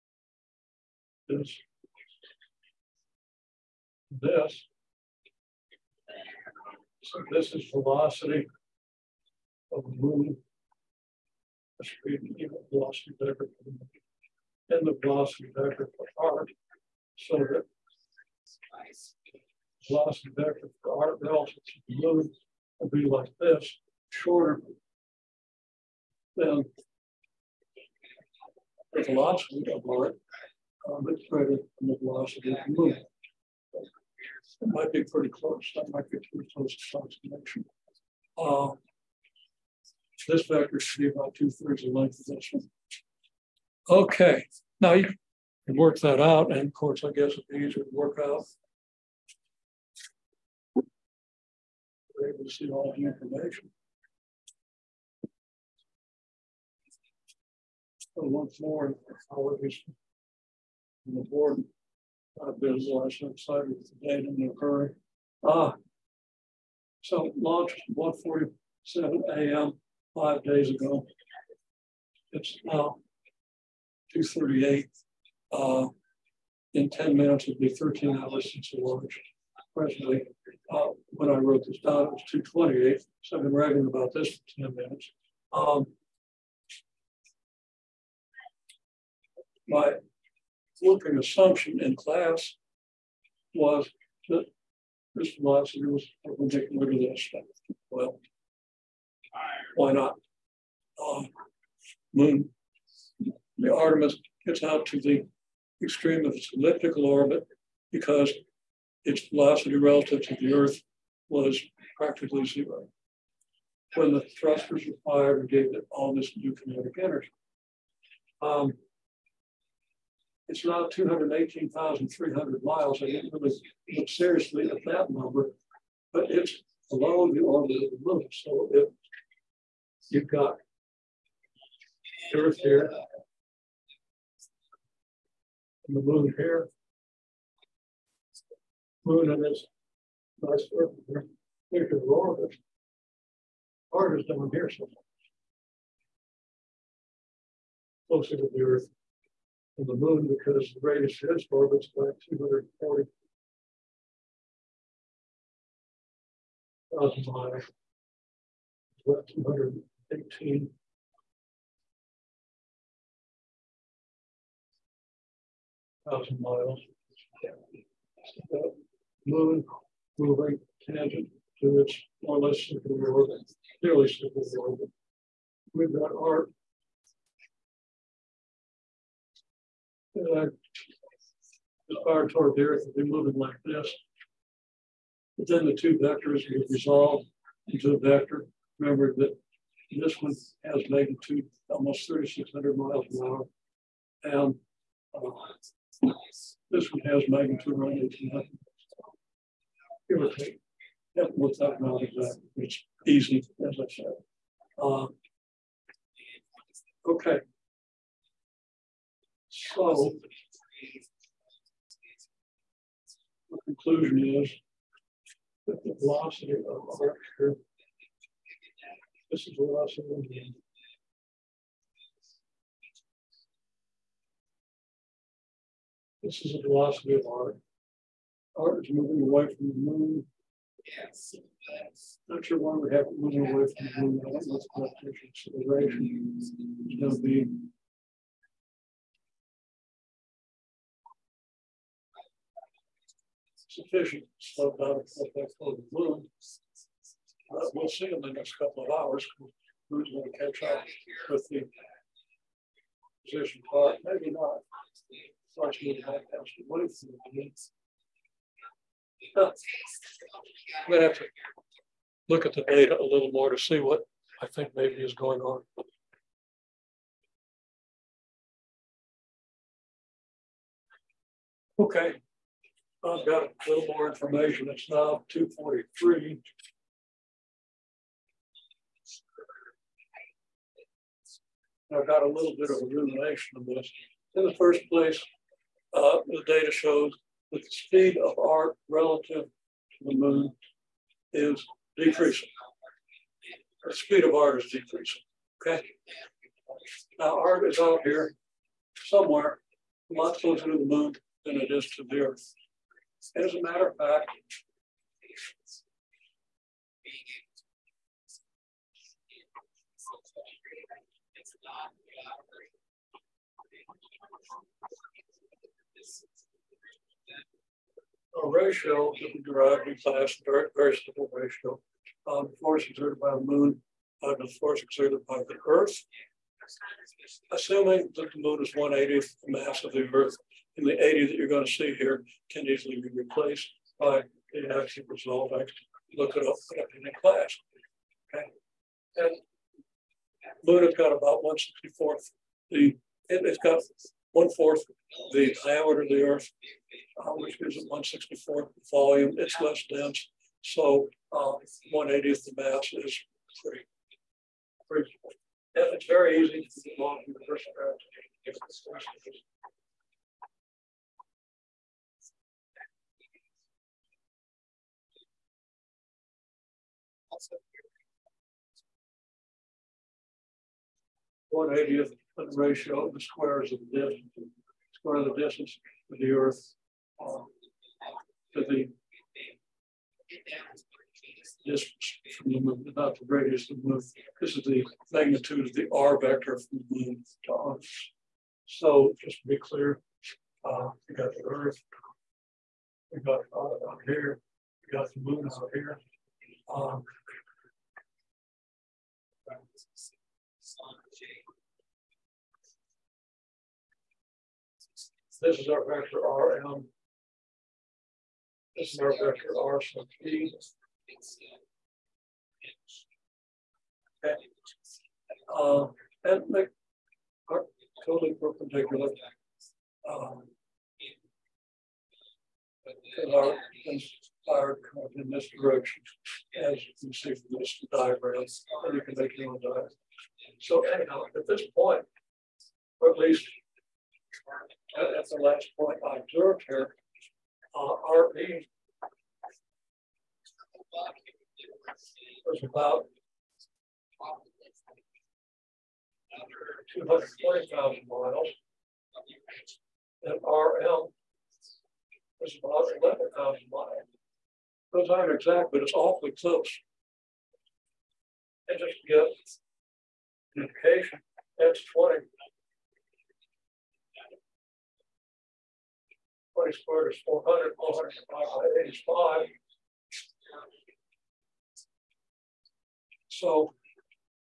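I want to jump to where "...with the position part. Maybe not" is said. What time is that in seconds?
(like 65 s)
251 s.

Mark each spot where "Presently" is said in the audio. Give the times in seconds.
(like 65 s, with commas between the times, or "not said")
79 s.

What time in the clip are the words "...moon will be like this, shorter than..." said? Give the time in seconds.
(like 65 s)
21 s.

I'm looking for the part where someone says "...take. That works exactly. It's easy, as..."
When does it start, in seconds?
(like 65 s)
200 s.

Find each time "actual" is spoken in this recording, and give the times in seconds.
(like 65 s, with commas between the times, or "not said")
334 s.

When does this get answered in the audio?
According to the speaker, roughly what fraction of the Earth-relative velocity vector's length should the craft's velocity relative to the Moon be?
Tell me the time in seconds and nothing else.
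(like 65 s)
41 s.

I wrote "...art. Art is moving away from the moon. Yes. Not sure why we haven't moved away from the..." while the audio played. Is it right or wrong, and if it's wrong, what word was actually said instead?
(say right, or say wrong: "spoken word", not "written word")
right.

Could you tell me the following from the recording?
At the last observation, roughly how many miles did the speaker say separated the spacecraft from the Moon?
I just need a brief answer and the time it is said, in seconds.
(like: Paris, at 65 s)
11,000 miles, at 453 s.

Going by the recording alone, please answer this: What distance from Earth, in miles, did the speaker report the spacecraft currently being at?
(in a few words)
218,300 miles.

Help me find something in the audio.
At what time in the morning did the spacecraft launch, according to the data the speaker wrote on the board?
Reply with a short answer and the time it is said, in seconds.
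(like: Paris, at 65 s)
1:47 a.m., at 67 s.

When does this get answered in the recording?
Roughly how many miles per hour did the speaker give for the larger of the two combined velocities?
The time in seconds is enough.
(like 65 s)
192 s.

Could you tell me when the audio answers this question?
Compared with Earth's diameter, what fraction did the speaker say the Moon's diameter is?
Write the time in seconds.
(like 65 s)
344 s.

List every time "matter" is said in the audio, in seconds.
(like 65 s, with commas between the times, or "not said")
303 s.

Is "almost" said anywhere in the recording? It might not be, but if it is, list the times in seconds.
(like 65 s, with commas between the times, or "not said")
191 s.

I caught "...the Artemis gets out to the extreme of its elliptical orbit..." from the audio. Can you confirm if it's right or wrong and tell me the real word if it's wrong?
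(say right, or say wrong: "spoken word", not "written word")
right.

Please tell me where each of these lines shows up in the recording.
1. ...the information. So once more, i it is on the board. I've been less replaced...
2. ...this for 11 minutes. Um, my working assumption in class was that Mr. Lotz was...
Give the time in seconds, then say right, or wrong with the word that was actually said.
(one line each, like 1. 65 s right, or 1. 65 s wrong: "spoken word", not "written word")
1. 52 s wrong: "excited", not "replaced"
2. 84 s wrong: "10", not "11".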